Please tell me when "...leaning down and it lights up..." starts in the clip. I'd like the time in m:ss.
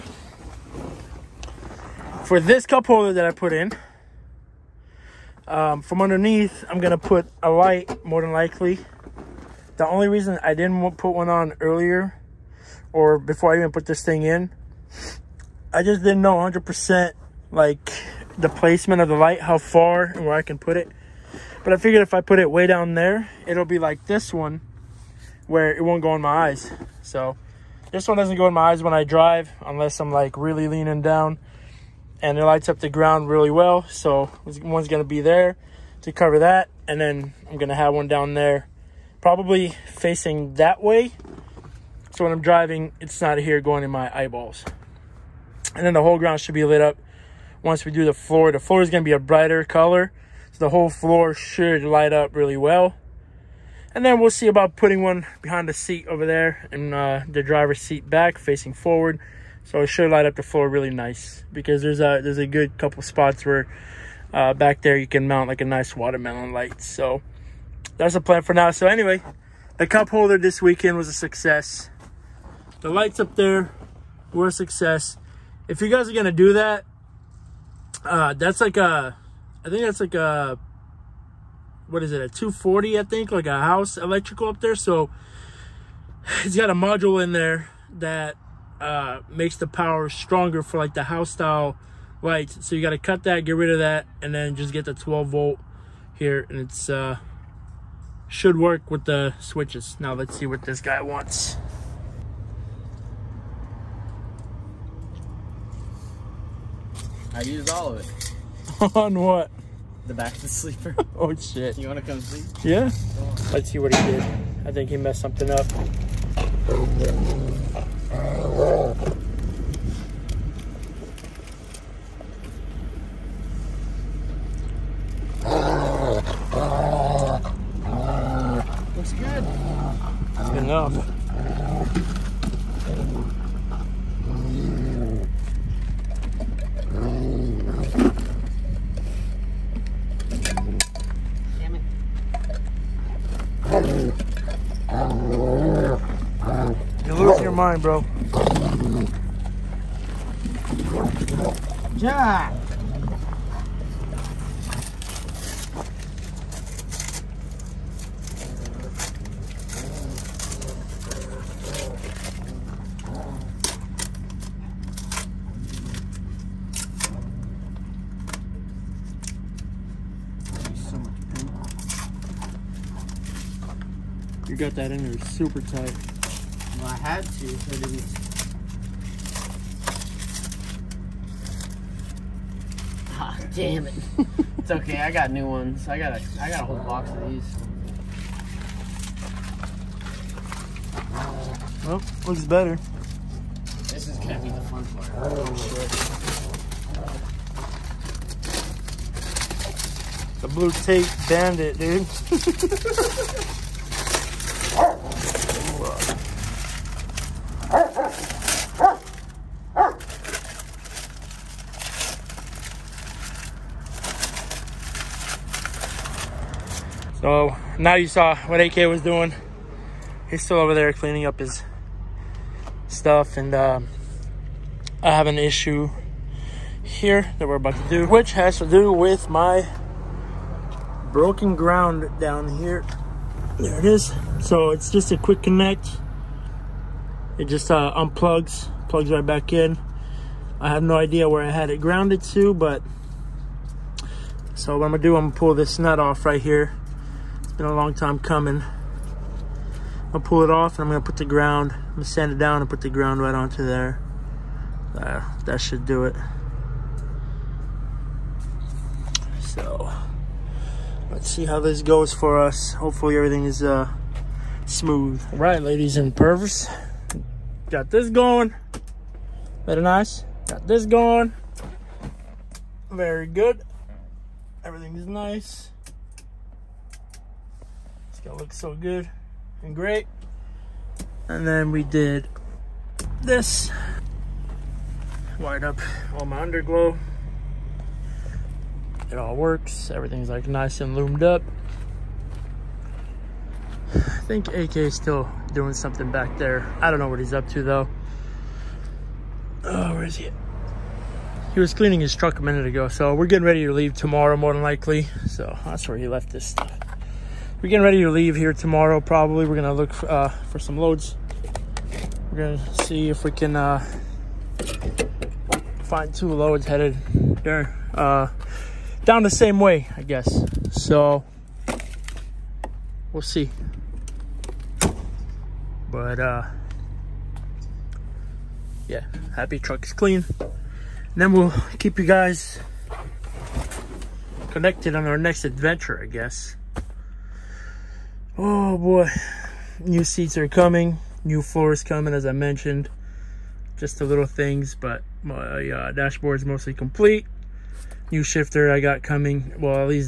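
0:30.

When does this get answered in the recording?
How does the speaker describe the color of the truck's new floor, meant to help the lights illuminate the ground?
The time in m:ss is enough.
0:49.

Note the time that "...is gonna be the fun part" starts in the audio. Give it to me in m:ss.
3:14.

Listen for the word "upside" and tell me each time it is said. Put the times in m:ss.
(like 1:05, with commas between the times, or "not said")
not said.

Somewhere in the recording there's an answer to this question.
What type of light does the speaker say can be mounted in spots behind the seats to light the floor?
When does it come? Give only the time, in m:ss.
1:05.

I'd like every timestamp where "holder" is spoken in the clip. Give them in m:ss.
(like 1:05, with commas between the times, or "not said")
0:02, 1:10.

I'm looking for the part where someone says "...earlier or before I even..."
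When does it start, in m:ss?
0:11.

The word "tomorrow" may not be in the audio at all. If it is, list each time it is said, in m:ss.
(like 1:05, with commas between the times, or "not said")
5:03, 5:08.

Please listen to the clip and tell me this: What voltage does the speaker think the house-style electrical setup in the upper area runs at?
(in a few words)
240.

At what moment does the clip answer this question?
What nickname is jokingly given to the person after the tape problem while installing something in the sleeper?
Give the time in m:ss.
3:20.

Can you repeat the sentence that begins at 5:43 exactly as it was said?
Just the little things, but my uh, is mostly complete.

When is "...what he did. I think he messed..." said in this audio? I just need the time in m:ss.
1:53.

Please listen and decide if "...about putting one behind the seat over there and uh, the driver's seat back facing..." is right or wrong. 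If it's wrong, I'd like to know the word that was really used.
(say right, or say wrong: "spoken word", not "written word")
right.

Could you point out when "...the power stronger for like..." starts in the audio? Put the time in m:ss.
1:29.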